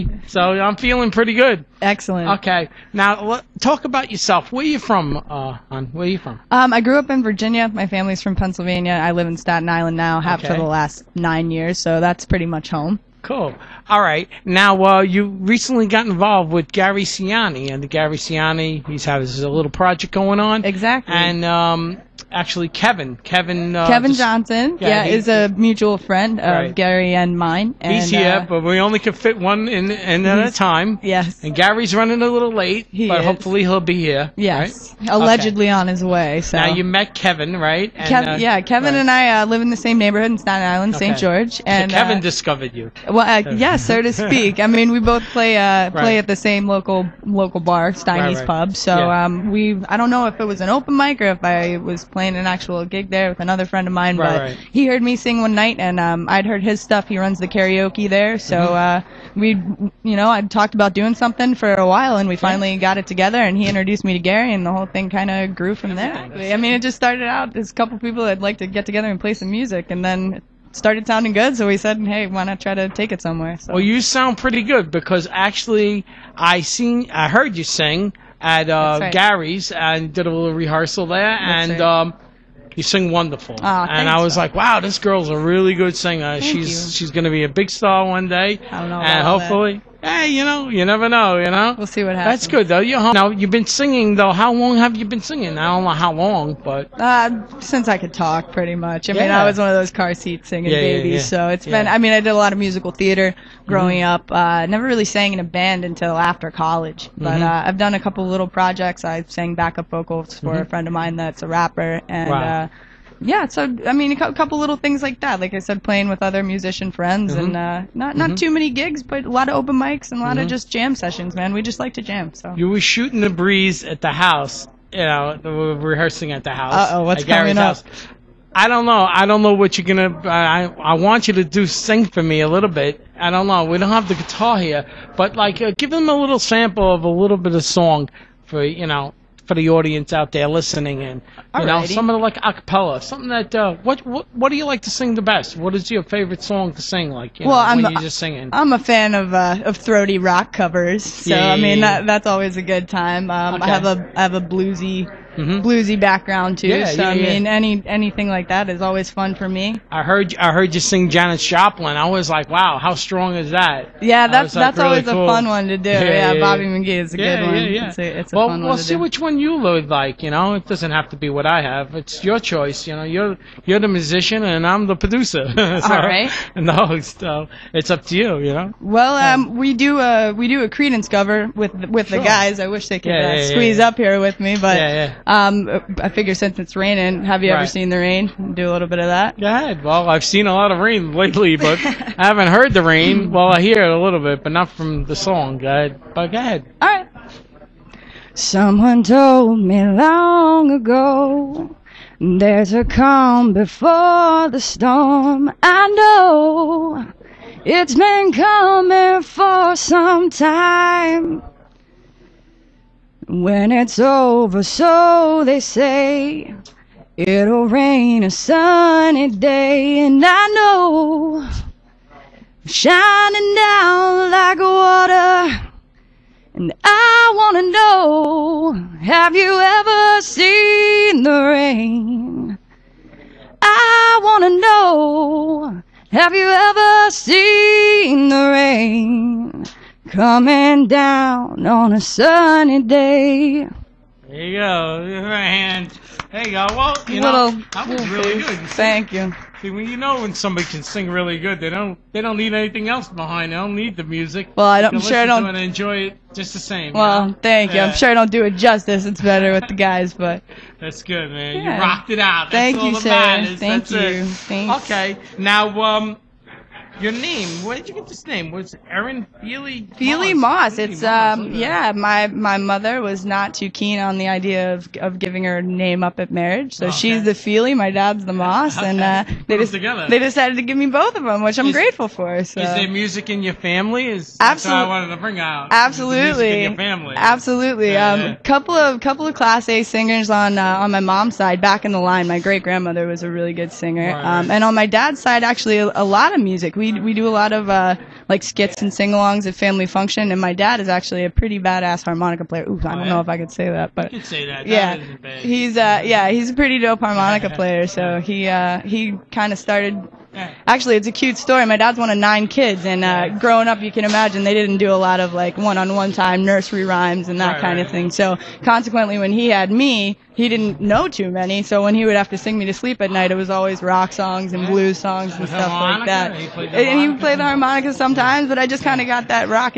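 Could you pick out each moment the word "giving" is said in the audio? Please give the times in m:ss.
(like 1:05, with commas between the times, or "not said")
4:35.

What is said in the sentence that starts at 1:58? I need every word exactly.
too many gigs, but a lot of open mics and a lot mm-hmm.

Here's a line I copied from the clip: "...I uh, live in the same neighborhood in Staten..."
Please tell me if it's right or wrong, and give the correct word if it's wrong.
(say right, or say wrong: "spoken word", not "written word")
right.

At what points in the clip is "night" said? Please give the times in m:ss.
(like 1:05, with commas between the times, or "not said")
0:55, 5:23.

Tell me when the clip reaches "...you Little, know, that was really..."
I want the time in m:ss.
4:07.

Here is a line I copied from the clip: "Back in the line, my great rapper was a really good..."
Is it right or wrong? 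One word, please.
wrong.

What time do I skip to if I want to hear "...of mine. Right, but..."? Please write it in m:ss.
0:53.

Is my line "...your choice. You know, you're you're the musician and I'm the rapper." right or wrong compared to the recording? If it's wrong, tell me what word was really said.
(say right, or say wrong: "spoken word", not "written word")
wrong: "producer", not "rapper".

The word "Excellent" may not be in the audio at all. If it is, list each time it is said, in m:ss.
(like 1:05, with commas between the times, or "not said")
0:01.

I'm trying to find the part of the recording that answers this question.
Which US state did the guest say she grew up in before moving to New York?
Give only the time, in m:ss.
0:07.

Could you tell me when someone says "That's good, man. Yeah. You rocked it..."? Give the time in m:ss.
4:20.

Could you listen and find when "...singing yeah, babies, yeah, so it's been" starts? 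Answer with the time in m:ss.
1:40.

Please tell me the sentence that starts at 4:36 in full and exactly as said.
she's the Feely, my dad's the Moss, okay.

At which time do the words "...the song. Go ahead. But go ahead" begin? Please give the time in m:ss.
3:15.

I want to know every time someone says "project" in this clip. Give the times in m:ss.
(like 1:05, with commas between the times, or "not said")
0:19, 1:48.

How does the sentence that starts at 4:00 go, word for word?
Coming down on a sunny day.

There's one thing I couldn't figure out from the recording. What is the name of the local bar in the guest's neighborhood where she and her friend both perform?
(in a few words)
Steiny's Pub.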